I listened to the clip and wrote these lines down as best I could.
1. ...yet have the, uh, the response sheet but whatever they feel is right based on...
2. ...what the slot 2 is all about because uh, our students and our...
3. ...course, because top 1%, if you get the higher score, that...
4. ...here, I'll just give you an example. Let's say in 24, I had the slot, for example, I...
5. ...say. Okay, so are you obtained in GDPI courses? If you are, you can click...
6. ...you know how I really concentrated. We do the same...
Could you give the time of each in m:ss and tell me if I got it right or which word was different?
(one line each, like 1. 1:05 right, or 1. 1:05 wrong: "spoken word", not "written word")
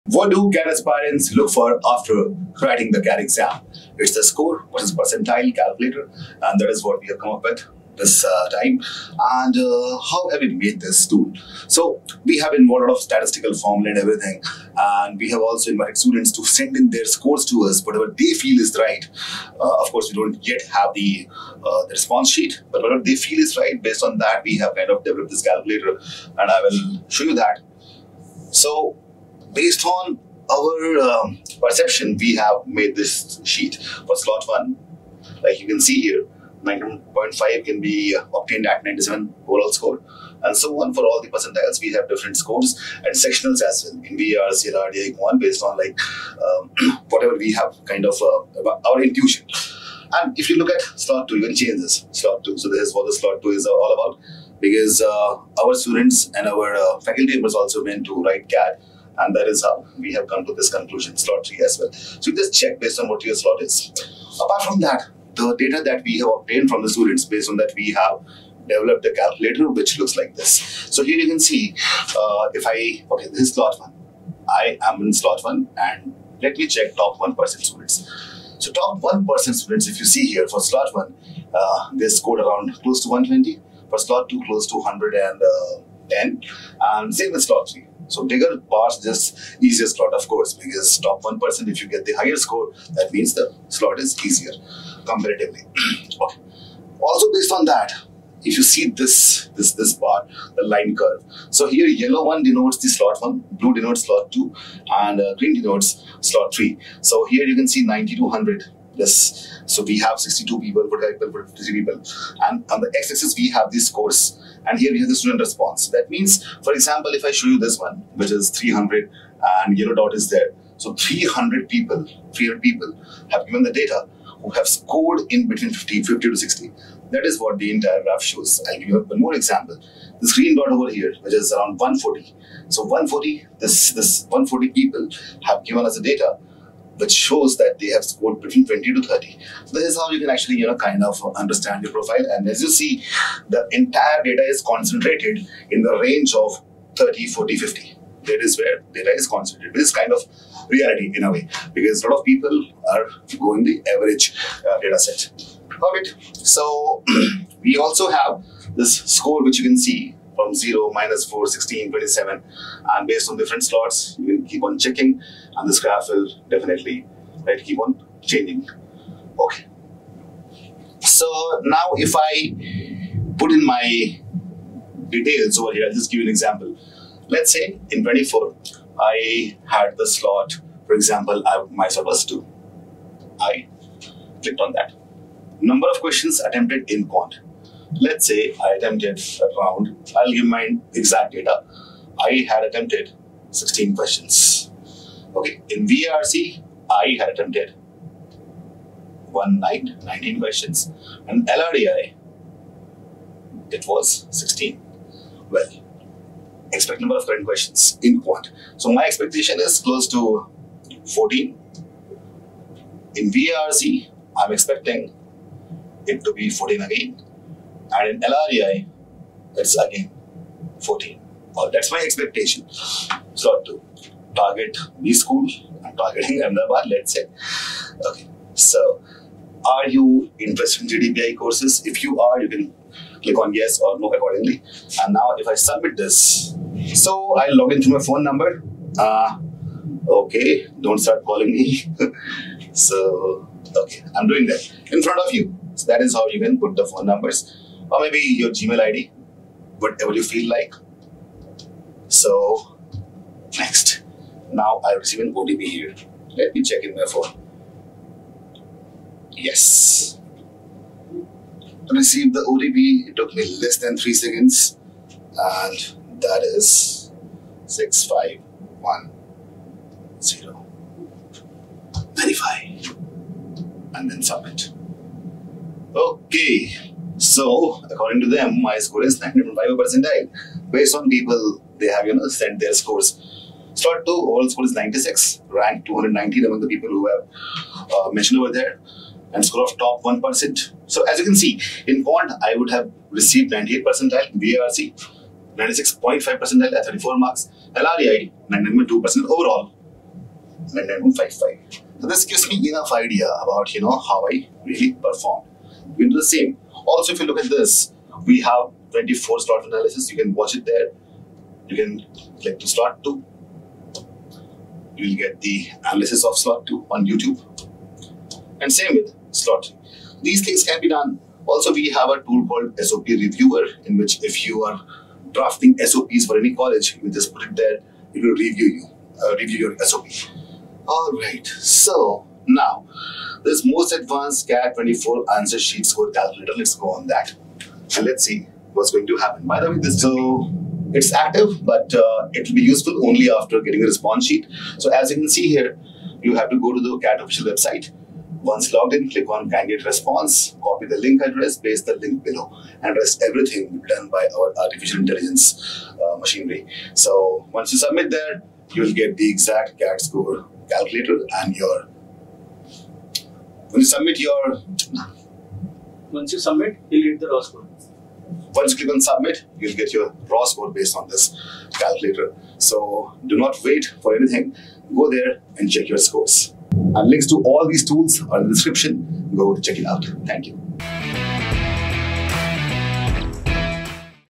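1. 0:20 right
2. 0:52 right
3. 1:30 right
4. 2:55 right
5. 3:47 wrong: "interested", not "obtained"
6. 5:03 wrong: "performed", not "concentrated".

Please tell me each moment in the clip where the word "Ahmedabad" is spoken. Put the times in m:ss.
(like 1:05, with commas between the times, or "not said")
3:46.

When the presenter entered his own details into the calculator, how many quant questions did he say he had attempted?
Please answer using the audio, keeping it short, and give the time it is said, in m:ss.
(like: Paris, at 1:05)
16, at 3:12.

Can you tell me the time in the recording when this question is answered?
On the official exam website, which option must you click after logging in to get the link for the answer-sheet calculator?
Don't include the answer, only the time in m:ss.
5:49.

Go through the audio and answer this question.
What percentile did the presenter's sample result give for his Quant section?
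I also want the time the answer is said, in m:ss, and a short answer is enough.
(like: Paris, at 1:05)
98, at 4:53.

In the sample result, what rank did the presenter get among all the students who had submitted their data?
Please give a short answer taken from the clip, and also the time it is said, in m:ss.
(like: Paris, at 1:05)
219, at 4:45.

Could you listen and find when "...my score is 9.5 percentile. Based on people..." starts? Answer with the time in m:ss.
4:38.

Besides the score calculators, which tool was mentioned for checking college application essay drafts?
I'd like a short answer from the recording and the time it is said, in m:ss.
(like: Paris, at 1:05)
SOP Reviewer, at 5:22.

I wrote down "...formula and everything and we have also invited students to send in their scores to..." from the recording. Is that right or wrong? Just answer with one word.
right.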